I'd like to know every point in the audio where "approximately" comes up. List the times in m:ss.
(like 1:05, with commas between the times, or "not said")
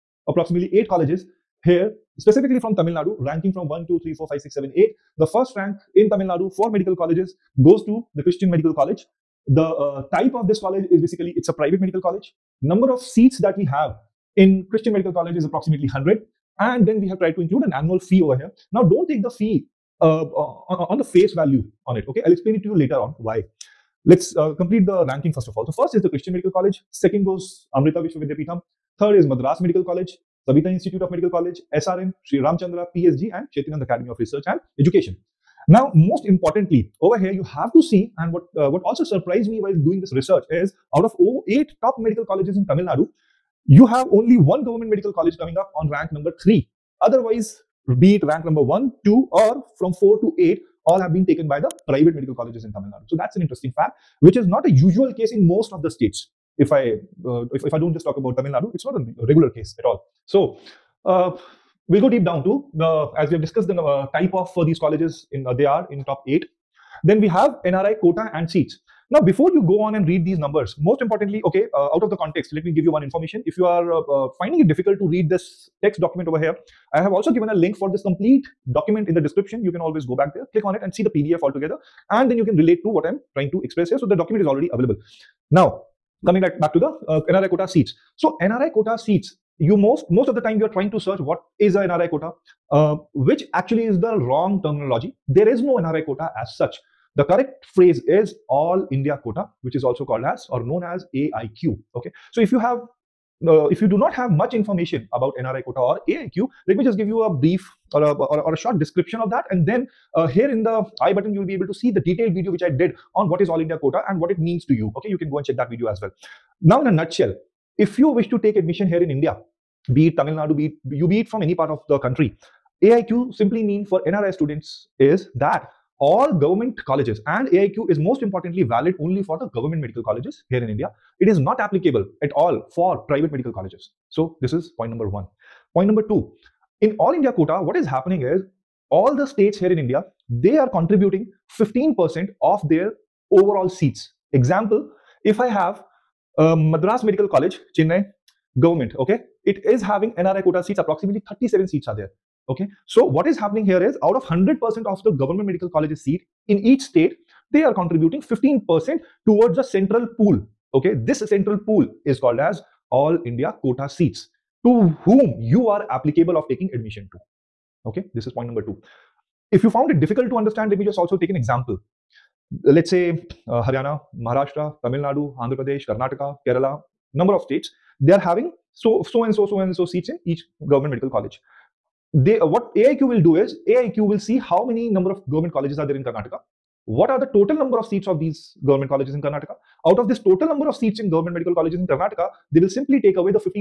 0:00, 0:15, 2:30.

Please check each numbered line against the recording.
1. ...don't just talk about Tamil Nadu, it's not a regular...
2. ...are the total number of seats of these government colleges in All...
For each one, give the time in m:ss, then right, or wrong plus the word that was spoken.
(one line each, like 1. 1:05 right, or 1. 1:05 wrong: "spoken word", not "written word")
1. 0:57 right
2. 3:07 wrong: "Karnataka", not "All".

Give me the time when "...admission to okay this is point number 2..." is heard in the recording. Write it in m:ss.
2:46.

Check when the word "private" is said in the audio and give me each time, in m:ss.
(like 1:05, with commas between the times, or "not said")
0:11, 0:51, 2:13.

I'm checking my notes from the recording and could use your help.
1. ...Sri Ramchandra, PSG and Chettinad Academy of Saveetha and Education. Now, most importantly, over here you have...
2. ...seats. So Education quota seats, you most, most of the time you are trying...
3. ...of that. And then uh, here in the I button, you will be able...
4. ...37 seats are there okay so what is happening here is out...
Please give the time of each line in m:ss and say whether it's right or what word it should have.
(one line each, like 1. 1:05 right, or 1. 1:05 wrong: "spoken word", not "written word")
1. 0:32 wrong: "Research", not "Saveetha"
2. 1:27 wrong: "NRI", not "Education"
3. 1:49 right
4. 2:31 right.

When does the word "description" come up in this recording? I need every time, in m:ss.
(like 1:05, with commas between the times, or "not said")
1:19, 1:48.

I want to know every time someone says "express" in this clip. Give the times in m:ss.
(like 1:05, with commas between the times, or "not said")
1:23.